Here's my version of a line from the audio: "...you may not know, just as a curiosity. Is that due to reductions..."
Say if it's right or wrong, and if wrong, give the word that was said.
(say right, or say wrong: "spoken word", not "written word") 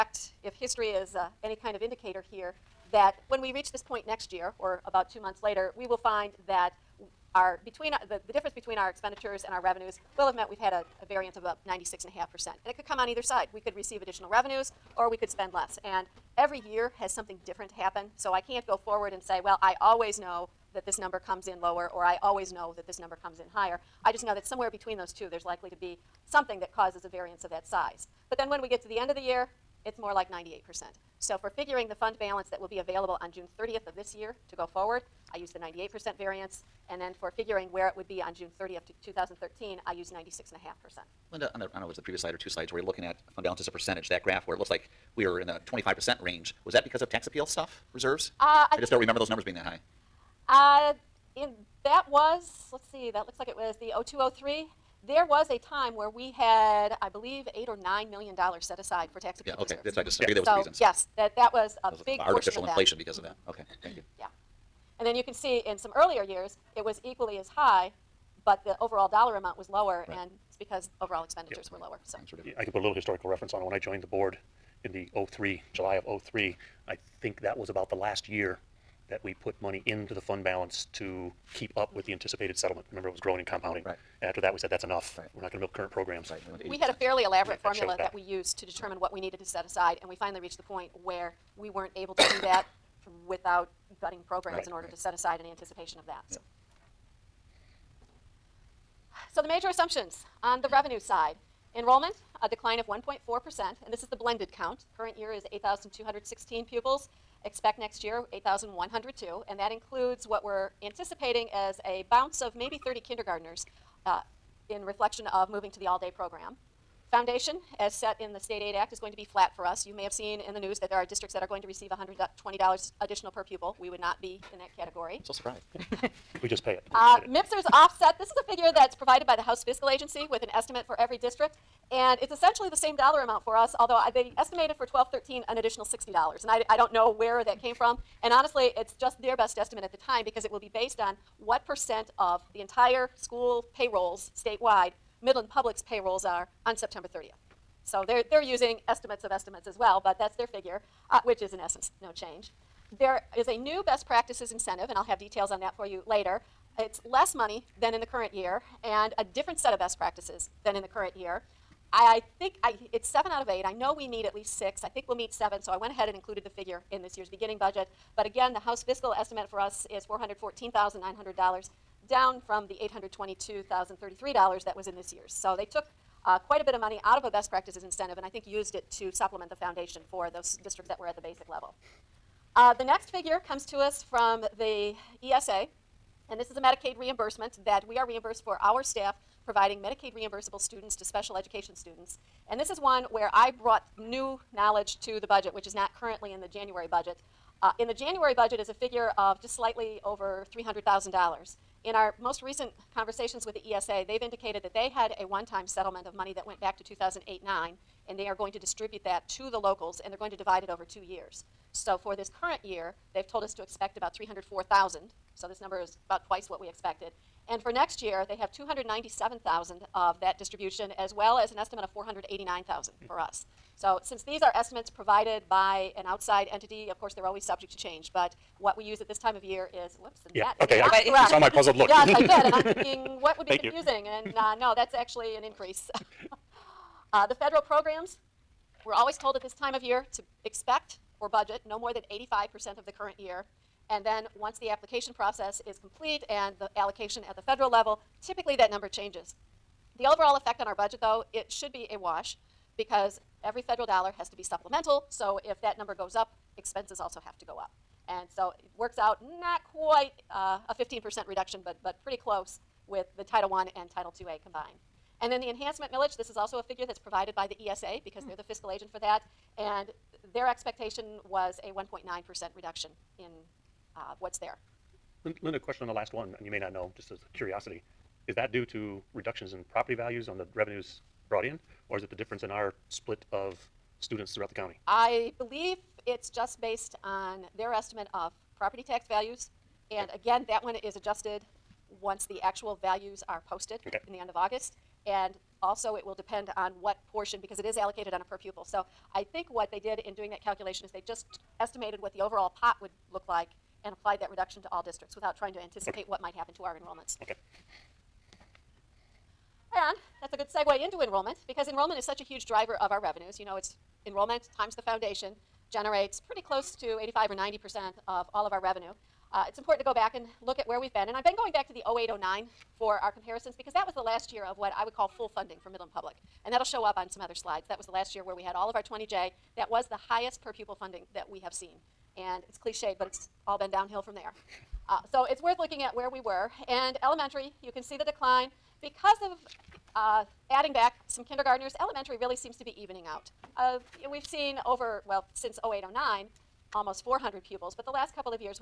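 right.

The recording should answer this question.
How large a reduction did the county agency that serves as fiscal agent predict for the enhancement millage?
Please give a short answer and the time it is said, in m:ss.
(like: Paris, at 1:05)
1.9%, at 4:31.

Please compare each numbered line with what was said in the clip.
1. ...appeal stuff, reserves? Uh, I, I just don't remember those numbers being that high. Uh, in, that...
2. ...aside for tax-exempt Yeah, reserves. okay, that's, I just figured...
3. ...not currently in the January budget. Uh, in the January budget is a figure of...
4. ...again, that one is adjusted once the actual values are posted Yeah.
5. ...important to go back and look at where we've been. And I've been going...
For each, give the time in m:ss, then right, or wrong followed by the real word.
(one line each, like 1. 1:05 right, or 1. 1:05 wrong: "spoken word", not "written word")
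1. 0:47 right
2. 0:58 right
3. 3:15 right
4. 4:50 wrong: "Okay", not "Yeah"
5. 5:19 right.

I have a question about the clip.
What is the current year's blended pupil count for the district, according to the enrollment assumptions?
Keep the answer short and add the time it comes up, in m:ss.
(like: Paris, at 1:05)
8,216, at 1:45.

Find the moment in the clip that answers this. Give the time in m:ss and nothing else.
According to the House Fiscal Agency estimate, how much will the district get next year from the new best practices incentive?
2:50.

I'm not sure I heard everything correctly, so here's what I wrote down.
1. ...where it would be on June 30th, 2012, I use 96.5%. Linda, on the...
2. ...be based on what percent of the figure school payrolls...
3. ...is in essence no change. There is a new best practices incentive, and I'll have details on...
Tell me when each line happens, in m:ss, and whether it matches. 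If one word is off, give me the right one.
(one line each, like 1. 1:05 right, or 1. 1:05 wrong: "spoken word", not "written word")
1. 0:37 wrong: "2013", not "2012"
2. 2:20 wrong: "entire", not "figure"
3. 2:31 right.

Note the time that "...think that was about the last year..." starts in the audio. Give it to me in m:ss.
1:17.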